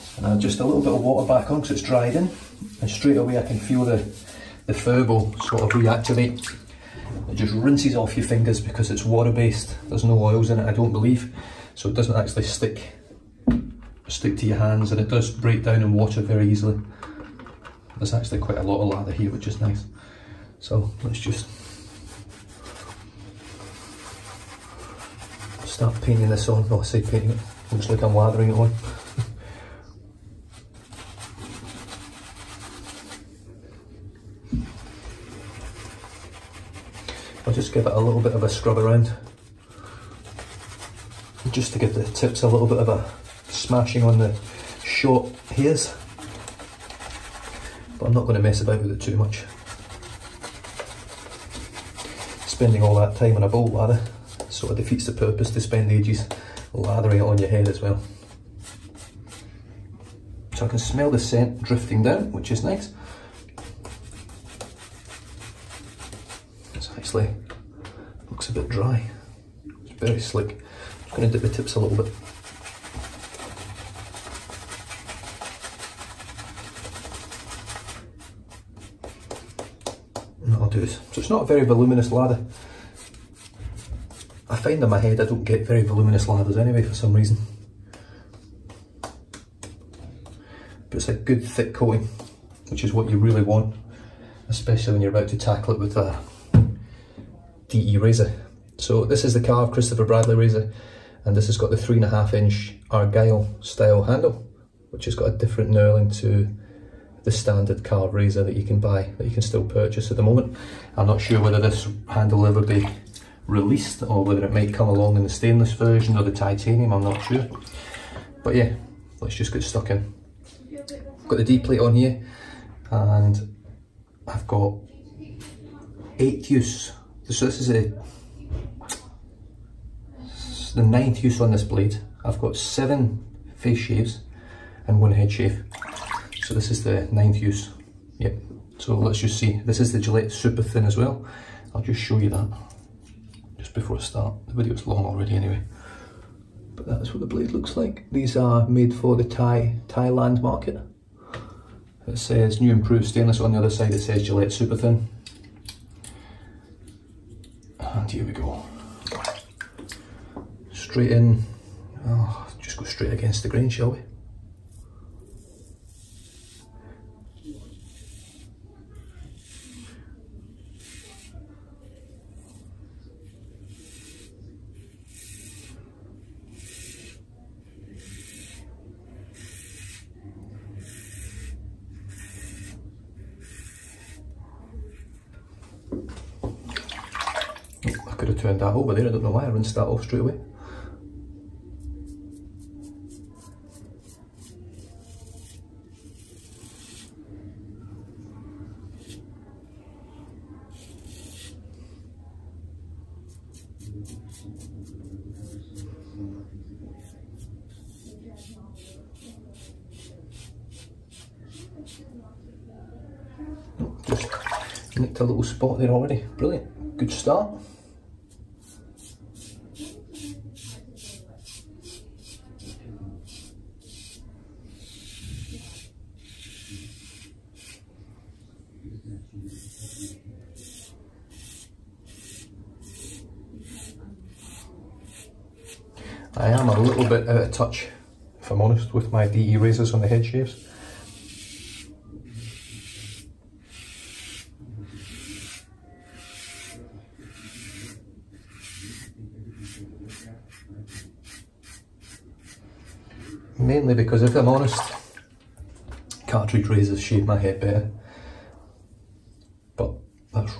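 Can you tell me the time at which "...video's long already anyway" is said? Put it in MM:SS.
02:24.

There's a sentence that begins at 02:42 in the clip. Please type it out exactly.
Oh, just go straight against the grain, shall we?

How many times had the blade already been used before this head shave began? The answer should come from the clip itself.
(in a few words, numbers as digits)
8.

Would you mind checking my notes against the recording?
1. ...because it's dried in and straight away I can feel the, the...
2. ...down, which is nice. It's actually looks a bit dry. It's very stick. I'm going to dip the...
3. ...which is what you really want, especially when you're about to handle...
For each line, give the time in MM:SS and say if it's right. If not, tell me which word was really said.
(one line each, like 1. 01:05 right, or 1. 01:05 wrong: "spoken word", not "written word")
1. 00:01 right
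2. 01:02 wrong: "slick", not "stick"
3. 01:32 wrong: "tackle", not "handle".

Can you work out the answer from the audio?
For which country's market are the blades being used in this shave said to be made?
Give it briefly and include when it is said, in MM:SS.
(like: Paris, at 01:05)
Thailand, at 02:29.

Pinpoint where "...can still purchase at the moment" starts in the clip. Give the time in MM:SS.
01:49.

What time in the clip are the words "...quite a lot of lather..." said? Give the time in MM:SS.
00:18.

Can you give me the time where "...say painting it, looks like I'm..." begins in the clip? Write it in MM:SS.
00:26.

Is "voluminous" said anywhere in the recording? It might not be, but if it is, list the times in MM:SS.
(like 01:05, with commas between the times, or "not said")
01:21, 01:25.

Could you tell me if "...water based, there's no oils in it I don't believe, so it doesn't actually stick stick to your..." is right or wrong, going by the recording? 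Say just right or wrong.
right.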